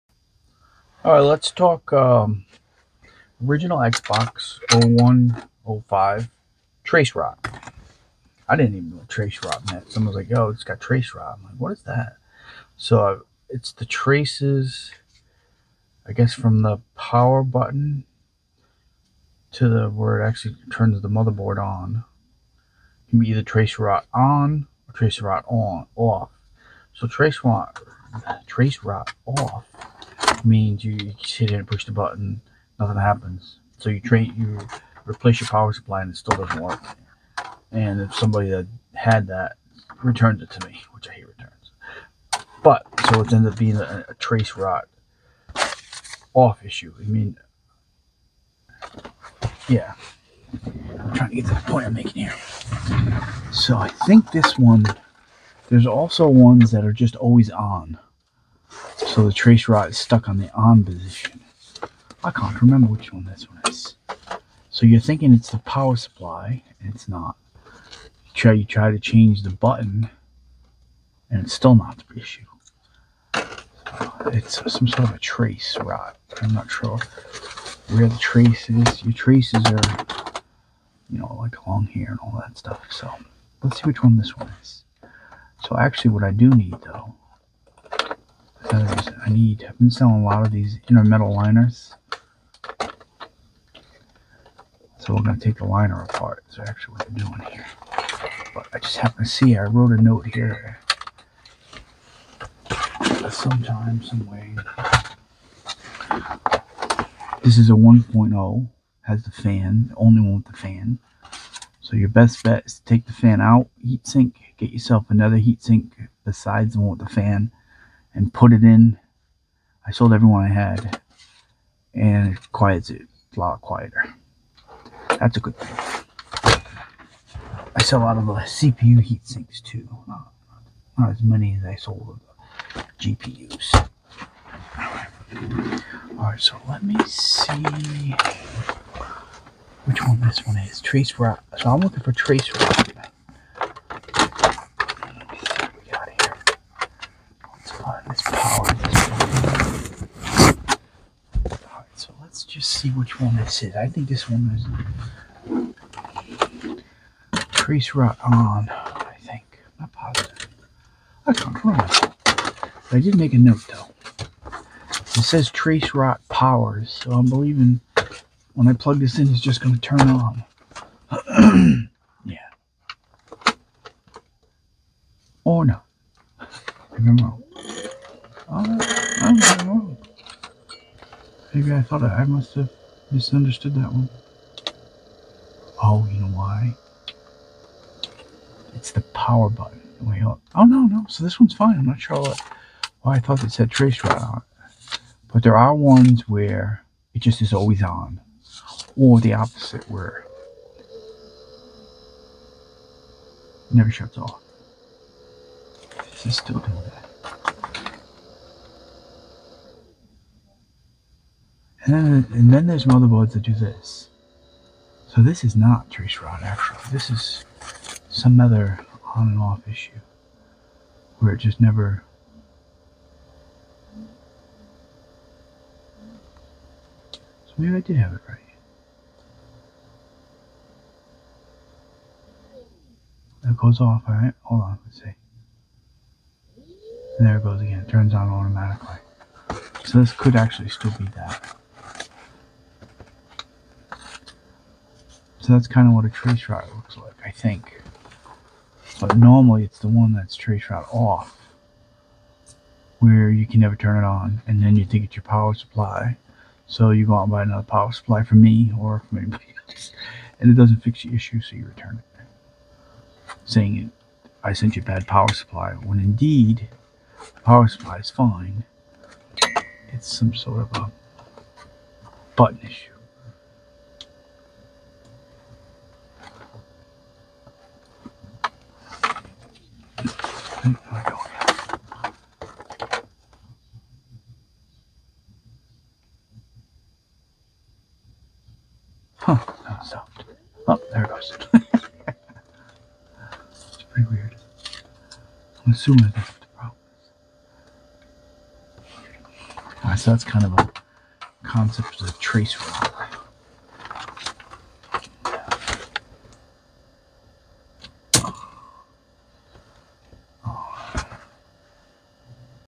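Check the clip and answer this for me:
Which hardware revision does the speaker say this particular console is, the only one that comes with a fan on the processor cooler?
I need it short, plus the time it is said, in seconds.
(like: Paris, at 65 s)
1.0, at 107 s.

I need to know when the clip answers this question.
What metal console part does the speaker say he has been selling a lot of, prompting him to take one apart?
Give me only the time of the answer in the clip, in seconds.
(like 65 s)
90 s.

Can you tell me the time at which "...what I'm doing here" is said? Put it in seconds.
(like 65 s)
96 s.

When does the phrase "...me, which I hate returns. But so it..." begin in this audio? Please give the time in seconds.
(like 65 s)
40 s.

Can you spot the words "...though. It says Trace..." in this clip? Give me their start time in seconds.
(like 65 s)
163 s.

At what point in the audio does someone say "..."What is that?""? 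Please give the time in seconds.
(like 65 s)
11 s.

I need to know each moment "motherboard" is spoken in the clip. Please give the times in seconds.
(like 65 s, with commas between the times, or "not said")
21 s, 212 s.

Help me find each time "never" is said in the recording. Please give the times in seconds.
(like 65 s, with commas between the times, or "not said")
203 s, 221 s, 253 s.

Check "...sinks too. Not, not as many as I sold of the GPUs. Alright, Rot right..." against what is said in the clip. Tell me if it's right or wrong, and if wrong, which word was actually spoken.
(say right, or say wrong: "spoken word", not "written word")
wrong: "All", not "Rot".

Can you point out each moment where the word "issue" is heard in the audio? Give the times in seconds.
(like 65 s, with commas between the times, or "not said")
46 s, 72 s, 219 s, 261 s, 272 s.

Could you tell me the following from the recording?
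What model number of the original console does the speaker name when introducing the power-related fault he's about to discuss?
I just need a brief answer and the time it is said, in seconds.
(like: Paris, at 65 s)
0105, at 4 s.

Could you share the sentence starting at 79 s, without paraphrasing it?
Your traces are, you know, like along here and all that stuff.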